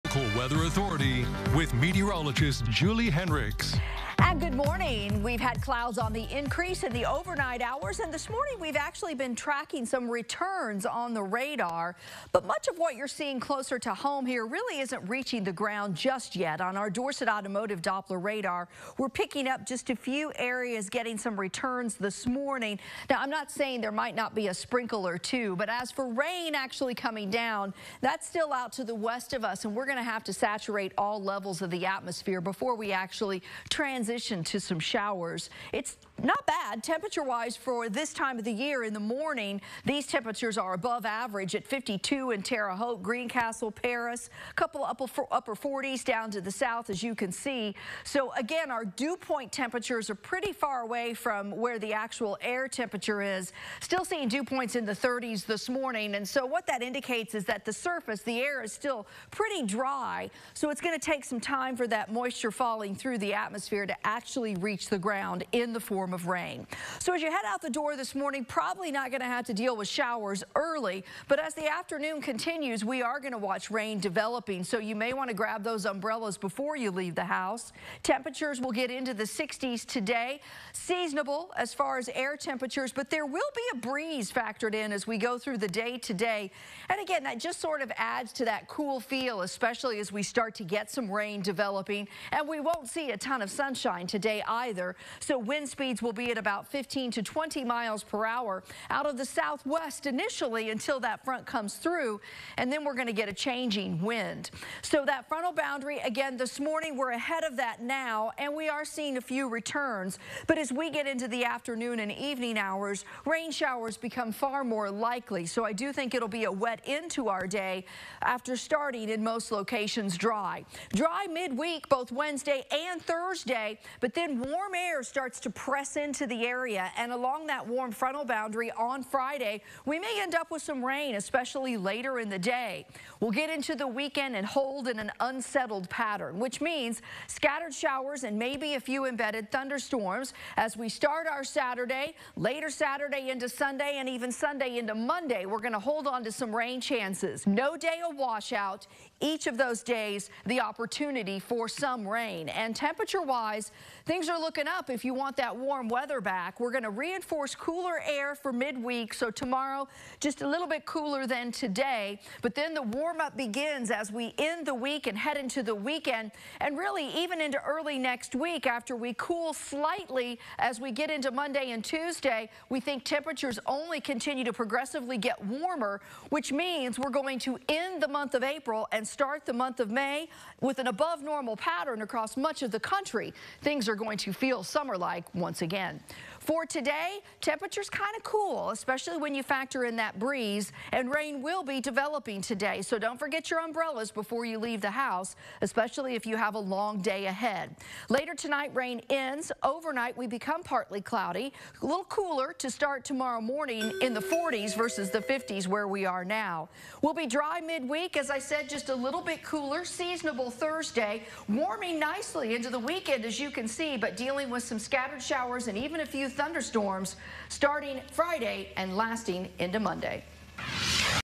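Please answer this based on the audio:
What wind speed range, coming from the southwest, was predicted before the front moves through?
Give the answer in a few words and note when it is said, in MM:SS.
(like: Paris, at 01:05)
15 to 20 miles per hour, at 01:36.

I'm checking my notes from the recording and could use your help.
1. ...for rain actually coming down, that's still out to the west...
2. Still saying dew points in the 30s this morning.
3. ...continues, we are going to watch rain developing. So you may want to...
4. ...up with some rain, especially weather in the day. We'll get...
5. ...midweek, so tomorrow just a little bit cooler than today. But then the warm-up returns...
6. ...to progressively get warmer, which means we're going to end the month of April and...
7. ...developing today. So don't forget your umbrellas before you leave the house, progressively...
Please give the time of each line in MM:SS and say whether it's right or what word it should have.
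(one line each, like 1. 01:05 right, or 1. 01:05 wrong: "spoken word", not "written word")
1. 00:25 right
2. 00:53 wrong: "seeing", not "saying"
3. 01:12 right
4. 02:10 wrong: "later", not "weather"
5. 02:38 wrong: "begins", not "returns"
6. 02:54 right
7. 03:11 wrong: "especially", not "progressively".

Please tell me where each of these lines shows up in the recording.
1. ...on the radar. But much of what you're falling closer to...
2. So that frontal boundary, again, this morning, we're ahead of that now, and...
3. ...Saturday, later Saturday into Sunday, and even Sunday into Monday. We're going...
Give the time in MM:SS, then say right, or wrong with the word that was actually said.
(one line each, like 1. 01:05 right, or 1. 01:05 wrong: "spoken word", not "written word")
1. 00:10 wrong: "seeing", not "falling"
2. 01:44 right
3. 02:21 right.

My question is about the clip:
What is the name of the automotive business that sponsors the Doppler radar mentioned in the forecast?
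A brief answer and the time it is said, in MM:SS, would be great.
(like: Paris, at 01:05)
Dorsett Automotive, at 00:16.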